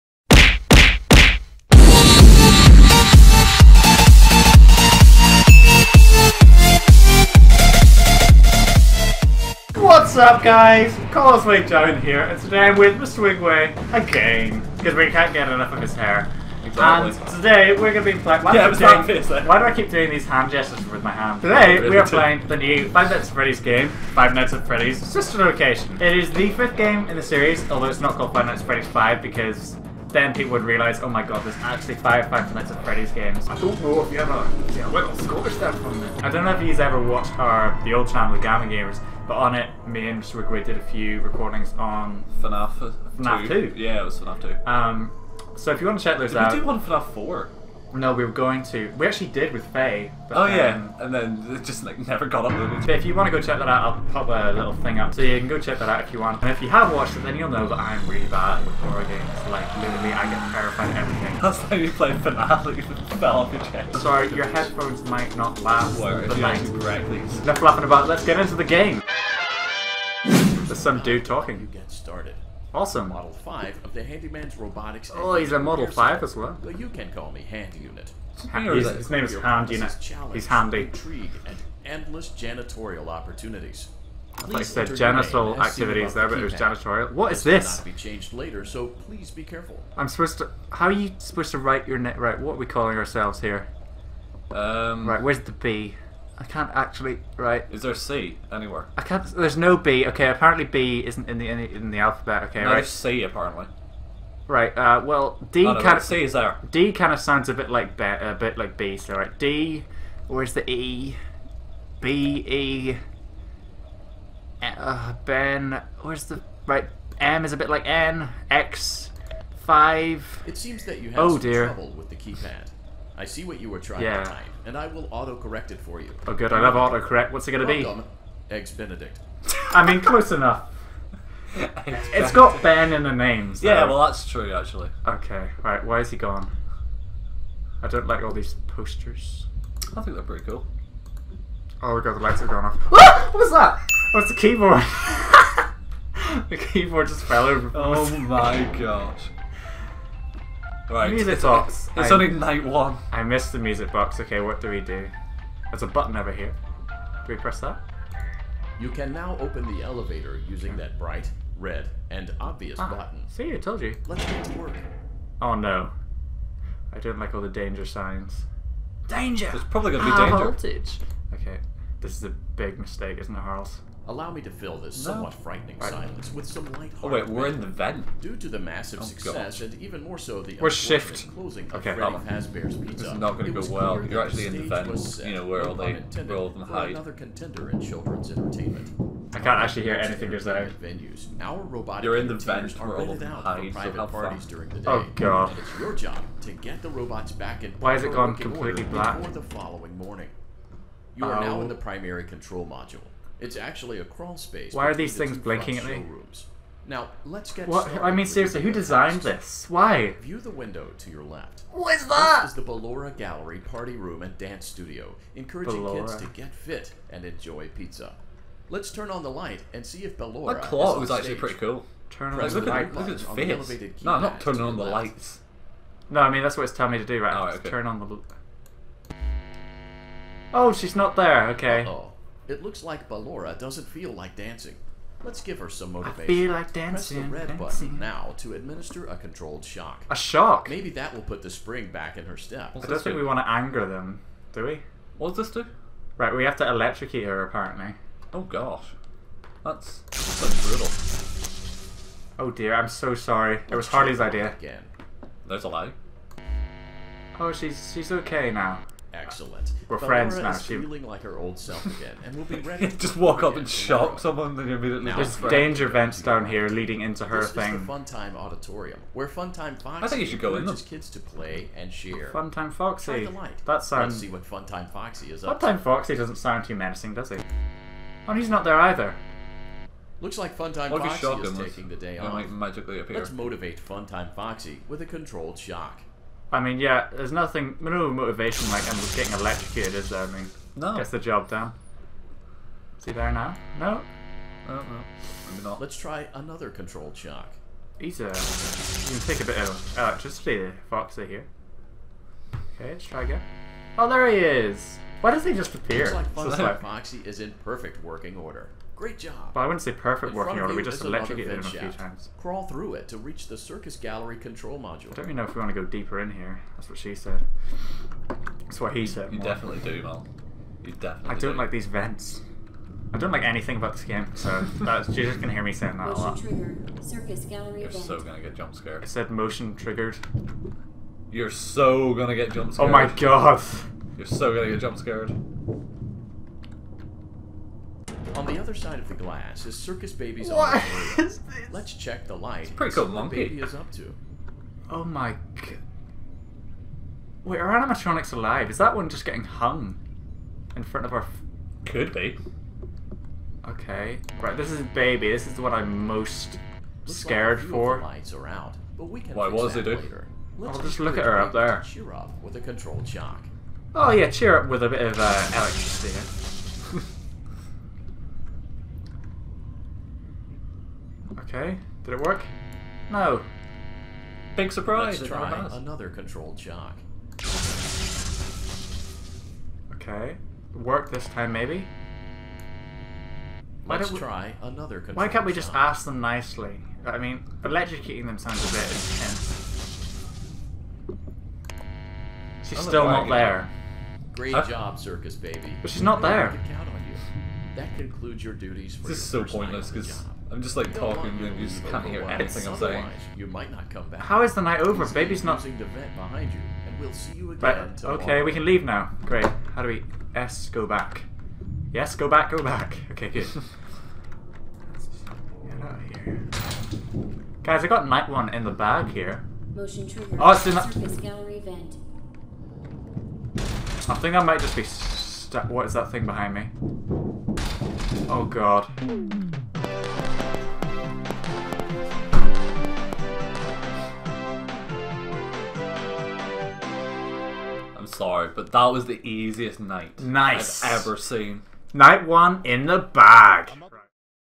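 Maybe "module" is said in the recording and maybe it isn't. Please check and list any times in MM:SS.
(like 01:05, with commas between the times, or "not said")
03:22, 05:14.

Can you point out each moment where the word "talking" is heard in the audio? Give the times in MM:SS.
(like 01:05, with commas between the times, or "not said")
01:11, 06:40.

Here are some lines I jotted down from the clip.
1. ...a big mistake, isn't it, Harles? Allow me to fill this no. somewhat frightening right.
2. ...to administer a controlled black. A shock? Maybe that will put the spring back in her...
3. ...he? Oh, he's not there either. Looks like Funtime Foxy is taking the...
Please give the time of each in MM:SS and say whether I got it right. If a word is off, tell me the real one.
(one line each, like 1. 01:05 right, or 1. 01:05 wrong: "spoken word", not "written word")
1. 02:52 right
2. 03:58 wrong: "shock", not "black"
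3. 04:37 right.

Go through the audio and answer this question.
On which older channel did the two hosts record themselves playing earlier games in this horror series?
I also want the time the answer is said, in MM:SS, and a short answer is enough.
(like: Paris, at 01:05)
The Gamma Gamers, at 00:38.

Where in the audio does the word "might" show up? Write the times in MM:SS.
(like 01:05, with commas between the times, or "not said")
01:05, 06:43, 07:04.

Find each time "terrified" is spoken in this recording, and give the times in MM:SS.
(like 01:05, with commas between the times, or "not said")
01:00.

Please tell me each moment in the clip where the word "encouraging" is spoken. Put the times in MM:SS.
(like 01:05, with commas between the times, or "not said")
03:35.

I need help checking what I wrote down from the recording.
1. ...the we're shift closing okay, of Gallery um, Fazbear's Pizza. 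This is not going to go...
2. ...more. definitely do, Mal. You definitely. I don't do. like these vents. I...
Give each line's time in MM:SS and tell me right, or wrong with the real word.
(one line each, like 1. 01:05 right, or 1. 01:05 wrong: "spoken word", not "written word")
1. 03:00 wrong: "Freddy", not "Gallery"
2. 05:19 right.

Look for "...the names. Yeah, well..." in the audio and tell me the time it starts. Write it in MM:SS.
02:13.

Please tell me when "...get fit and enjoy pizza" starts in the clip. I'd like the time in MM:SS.
03:36.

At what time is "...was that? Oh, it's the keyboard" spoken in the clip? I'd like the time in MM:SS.
02:23.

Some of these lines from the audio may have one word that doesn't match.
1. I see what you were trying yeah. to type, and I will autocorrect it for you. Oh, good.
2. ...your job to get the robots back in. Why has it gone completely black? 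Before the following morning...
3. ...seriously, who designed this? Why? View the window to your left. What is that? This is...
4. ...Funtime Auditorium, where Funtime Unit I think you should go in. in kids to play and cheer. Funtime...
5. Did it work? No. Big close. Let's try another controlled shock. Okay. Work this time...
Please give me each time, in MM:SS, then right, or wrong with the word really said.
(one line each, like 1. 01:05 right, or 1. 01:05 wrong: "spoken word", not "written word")
1. 02:03 right
2. 03:15 right
3. 03:28 right
4. 04:27 wrong: "Foxy", not "Unit"
5. 06:12 wrong: "surprise", not "close".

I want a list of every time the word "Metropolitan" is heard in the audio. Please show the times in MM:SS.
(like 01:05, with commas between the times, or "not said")
not said.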